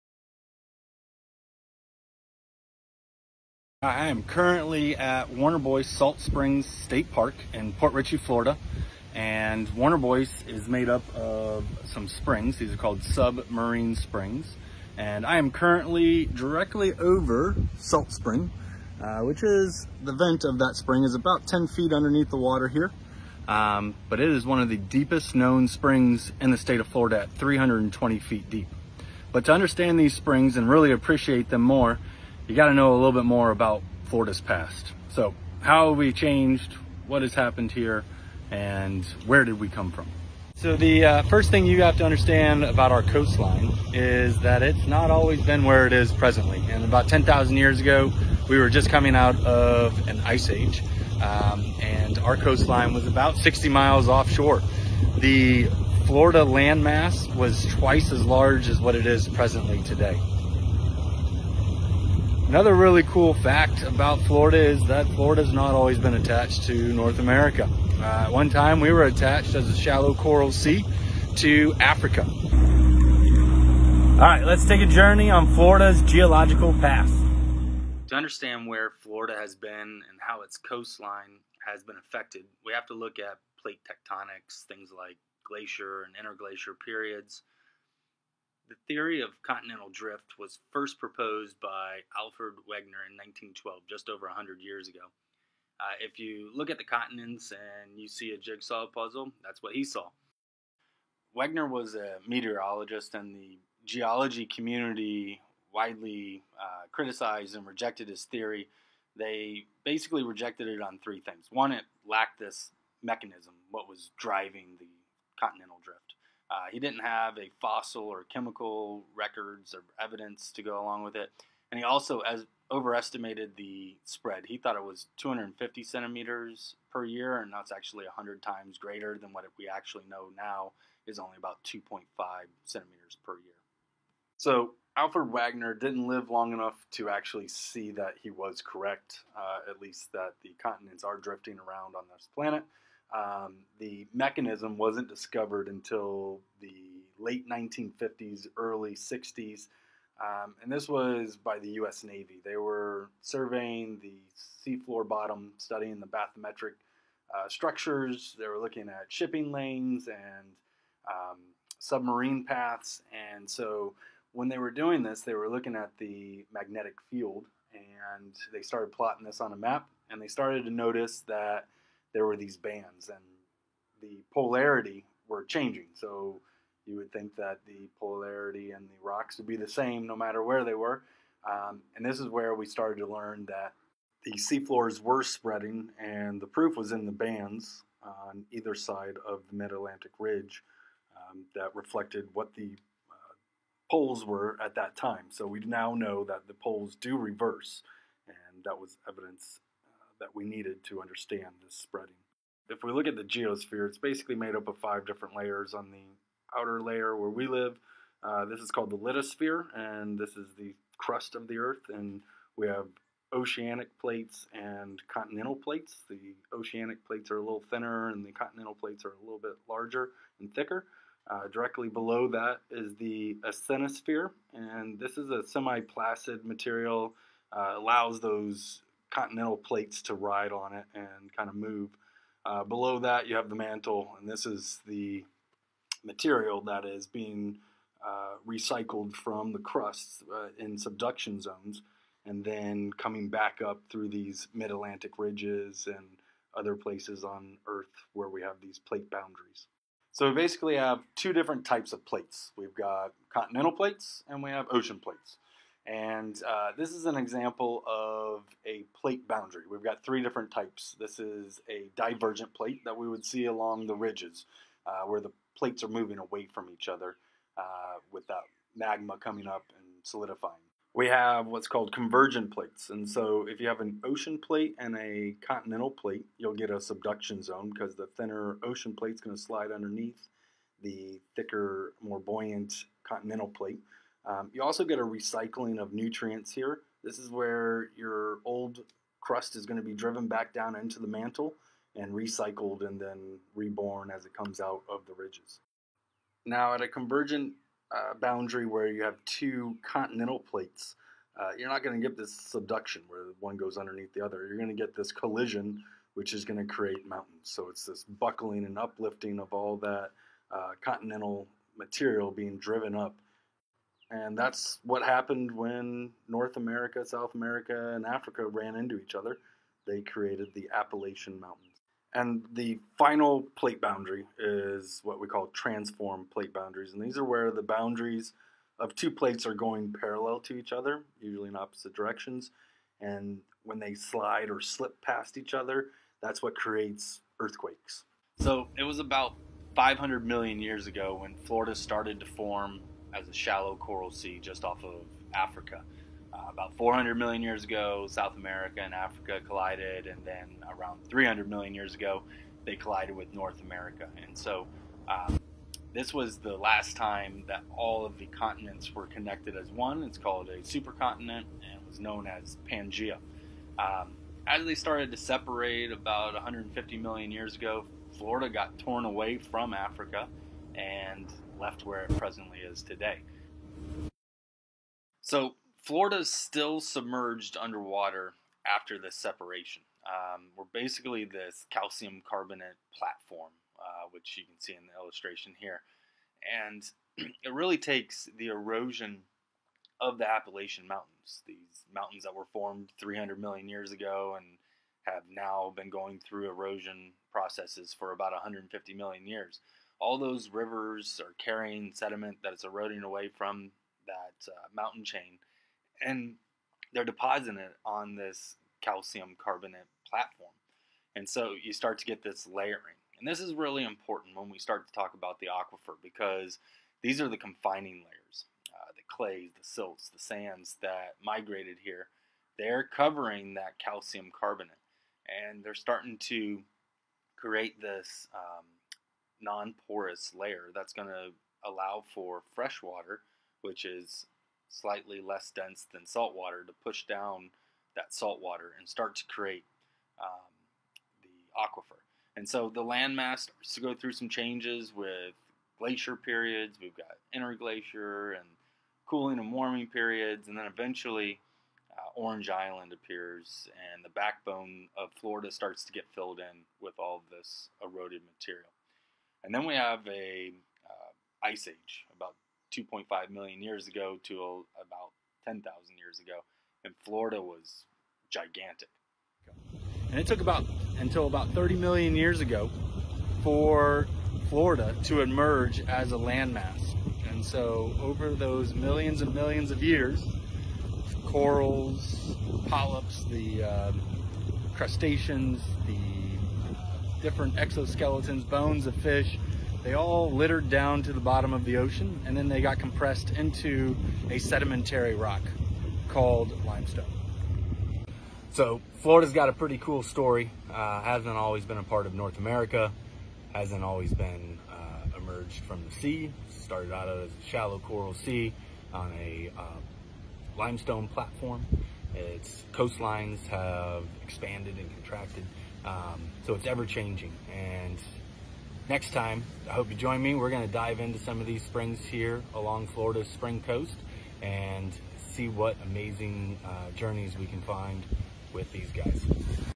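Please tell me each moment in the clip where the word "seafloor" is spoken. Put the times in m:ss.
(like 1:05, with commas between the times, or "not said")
2:34, 3:04.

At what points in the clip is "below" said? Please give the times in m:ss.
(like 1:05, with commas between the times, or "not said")
3:41, 3:52.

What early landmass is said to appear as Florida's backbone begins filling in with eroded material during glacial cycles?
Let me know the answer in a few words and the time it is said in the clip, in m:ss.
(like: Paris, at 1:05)
Orange Island, at 7:32.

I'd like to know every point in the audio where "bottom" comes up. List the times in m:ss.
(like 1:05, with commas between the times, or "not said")
2:35, 8:11.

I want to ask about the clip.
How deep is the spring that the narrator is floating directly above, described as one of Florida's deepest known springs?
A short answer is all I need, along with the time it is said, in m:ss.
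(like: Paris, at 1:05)
320 feet, at 0:27.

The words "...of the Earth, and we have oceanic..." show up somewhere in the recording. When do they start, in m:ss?
3:31.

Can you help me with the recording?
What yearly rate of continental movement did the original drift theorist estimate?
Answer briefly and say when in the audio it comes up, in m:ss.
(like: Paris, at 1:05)
250 centimeters per year, at 2:05.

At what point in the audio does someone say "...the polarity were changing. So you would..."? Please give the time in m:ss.
2:54.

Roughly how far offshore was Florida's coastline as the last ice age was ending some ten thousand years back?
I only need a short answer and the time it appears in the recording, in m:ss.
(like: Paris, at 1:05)
60 miles, at 0:53.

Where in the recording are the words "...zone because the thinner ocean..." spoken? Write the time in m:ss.
4:37.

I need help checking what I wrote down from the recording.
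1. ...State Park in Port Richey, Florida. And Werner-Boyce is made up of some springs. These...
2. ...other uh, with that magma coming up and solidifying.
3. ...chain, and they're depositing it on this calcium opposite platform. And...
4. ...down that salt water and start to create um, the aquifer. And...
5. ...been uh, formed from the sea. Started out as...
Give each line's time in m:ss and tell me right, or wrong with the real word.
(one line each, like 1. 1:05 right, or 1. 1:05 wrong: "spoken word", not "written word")
1. 0:06 right
2. 4:26 right
3. 6:45 wrong: "carbonate", not "opposite"
4. 7:17 right
5. 8:24 wrong: "emerged", not "formed".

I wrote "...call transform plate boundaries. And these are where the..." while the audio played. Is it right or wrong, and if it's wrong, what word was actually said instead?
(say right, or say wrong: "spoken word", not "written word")
right.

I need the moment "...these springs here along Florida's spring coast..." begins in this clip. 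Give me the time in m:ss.
8:41.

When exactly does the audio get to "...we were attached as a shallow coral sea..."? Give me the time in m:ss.
1:08.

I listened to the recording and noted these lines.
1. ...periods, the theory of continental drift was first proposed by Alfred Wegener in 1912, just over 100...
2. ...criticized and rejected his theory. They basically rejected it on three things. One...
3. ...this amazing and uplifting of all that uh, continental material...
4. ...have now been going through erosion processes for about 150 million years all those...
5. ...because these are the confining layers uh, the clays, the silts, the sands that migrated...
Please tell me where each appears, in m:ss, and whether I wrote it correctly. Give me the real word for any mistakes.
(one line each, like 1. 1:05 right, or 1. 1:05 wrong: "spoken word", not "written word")
1. 1:26 right
2. 1:46 right
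3. 5:07 wrong: "buckling", not "amazing"
4. 6:35 right
5. 6:56 right.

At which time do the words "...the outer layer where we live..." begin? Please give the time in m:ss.
3:25.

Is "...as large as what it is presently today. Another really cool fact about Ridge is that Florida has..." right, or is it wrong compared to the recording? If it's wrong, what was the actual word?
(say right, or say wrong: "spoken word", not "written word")
wrong: "Florida", not "Ridge".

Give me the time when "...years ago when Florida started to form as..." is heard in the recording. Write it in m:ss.
5:40.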